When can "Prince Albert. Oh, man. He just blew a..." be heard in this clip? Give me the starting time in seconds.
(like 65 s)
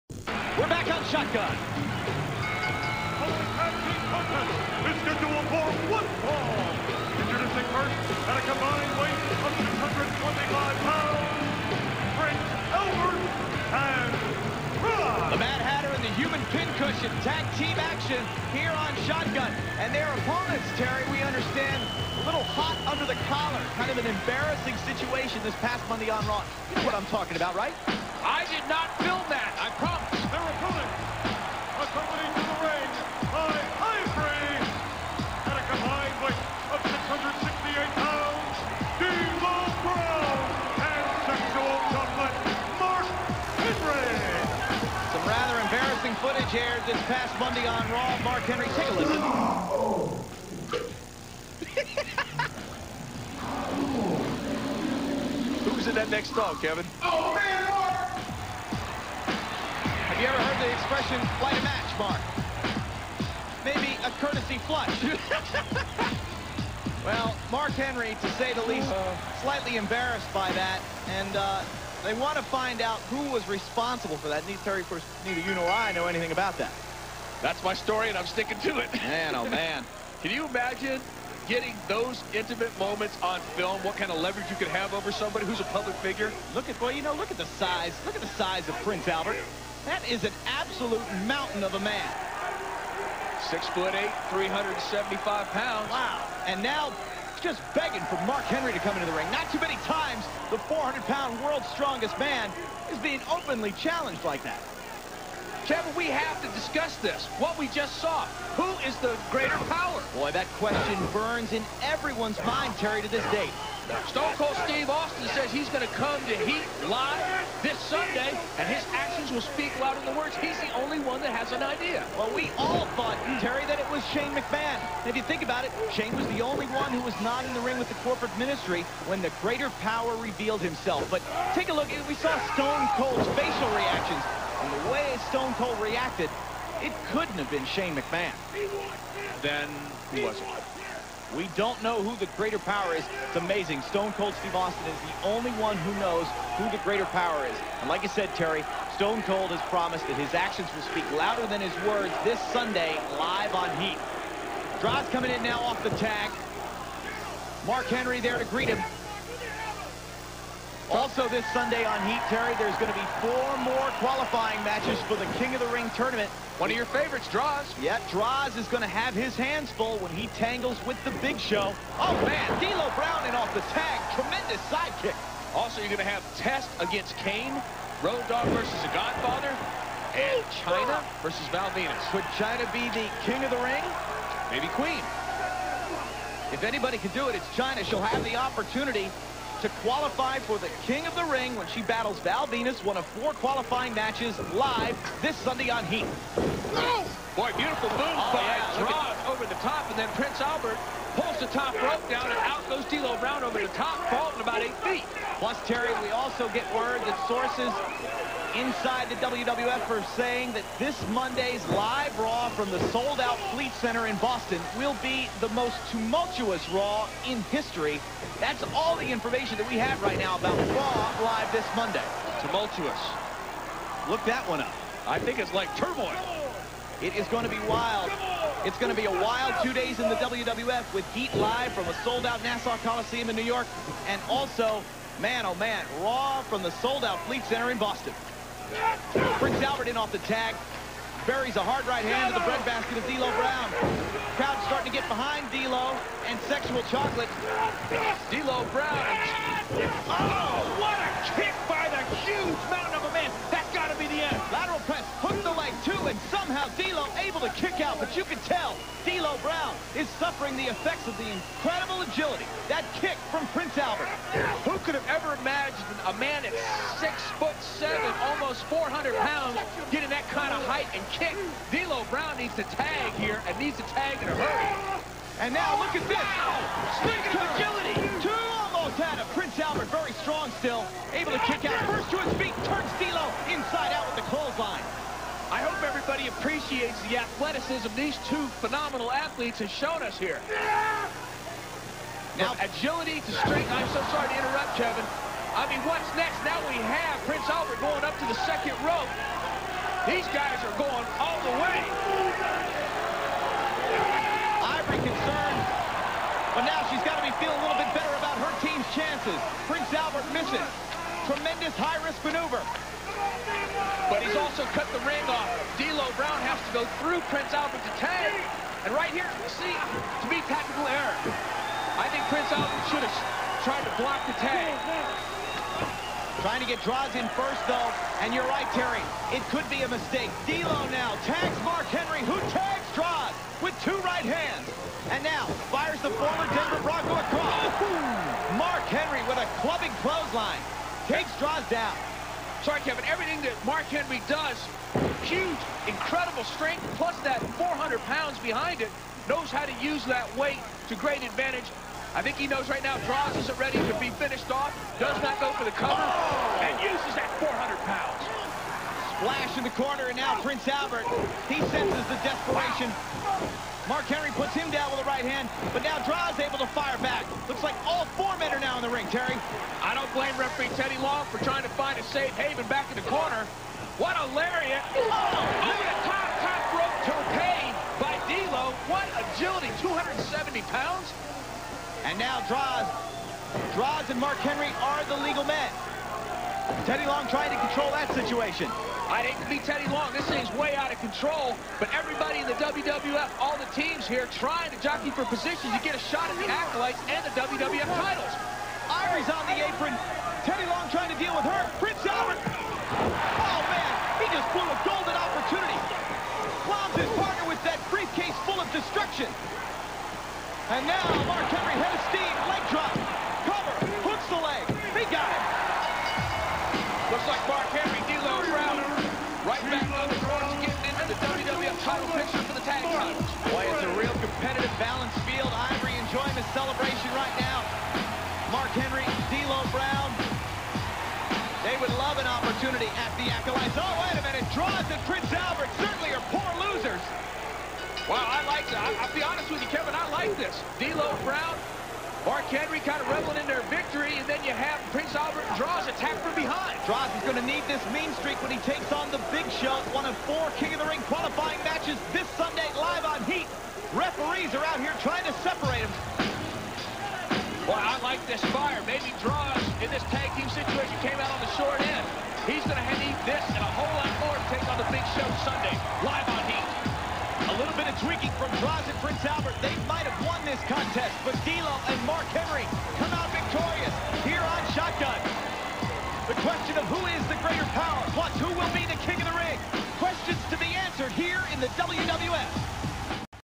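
401 s.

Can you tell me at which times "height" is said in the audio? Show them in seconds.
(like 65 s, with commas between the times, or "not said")
270 s.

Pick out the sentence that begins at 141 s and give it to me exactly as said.
We don't know who the greater power is.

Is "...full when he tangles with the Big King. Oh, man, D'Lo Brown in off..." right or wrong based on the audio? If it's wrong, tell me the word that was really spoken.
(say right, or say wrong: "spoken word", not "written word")
wrong: "Show", not "King".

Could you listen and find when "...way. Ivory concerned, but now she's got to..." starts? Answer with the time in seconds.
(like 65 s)
301 s.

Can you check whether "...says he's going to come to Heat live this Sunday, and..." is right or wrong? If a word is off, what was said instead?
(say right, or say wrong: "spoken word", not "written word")
right.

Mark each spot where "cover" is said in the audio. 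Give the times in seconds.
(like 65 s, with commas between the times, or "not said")
355 s, 413 s.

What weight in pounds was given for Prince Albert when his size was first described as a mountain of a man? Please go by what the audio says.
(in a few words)
375.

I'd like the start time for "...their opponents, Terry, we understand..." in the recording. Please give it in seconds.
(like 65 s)
19 s.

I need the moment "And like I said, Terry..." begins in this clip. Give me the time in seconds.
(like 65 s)
147 s.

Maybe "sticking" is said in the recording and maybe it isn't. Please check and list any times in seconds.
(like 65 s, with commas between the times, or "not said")
78 s.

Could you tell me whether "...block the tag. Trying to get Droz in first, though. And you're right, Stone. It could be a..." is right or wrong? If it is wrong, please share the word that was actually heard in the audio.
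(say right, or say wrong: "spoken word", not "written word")
wrong: "Terry", not "Stone".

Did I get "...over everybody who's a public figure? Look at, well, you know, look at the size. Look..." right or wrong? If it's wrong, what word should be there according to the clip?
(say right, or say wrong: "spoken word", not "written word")
wrong: "somebody", not "everybody".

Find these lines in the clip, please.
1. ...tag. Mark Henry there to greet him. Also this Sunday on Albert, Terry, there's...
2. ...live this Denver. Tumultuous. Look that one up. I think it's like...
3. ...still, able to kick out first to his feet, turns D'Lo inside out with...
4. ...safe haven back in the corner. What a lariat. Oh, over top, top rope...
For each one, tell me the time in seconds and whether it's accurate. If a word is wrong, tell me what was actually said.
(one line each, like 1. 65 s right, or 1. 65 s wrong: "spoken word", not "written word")
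1. 155 s wrong: "Heat", not "Albert"
2. 221 s wrong: "Monday", not "Denver"
3. 280 s right
4. 372 s right.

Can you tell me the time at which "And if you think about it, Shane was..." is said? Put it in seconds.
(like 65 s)
125 s.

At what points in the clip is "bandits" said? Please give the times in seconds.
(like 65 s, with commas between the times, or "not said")
not said.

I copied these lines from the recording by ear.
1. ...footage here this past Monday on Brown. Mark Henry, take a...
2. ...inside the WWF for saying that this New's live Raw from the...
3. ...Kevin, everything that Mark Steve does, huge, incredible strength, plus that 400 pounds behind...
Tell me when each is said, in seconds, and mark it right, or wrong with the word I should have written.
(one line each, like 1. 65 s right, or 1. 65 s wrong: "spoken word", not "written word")
1. 46 s wrong: "Raw", not "Brown"
2. 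208 s wrong: "Monday", not "New"
3. 342 s wrong: "Henry", not "Steve".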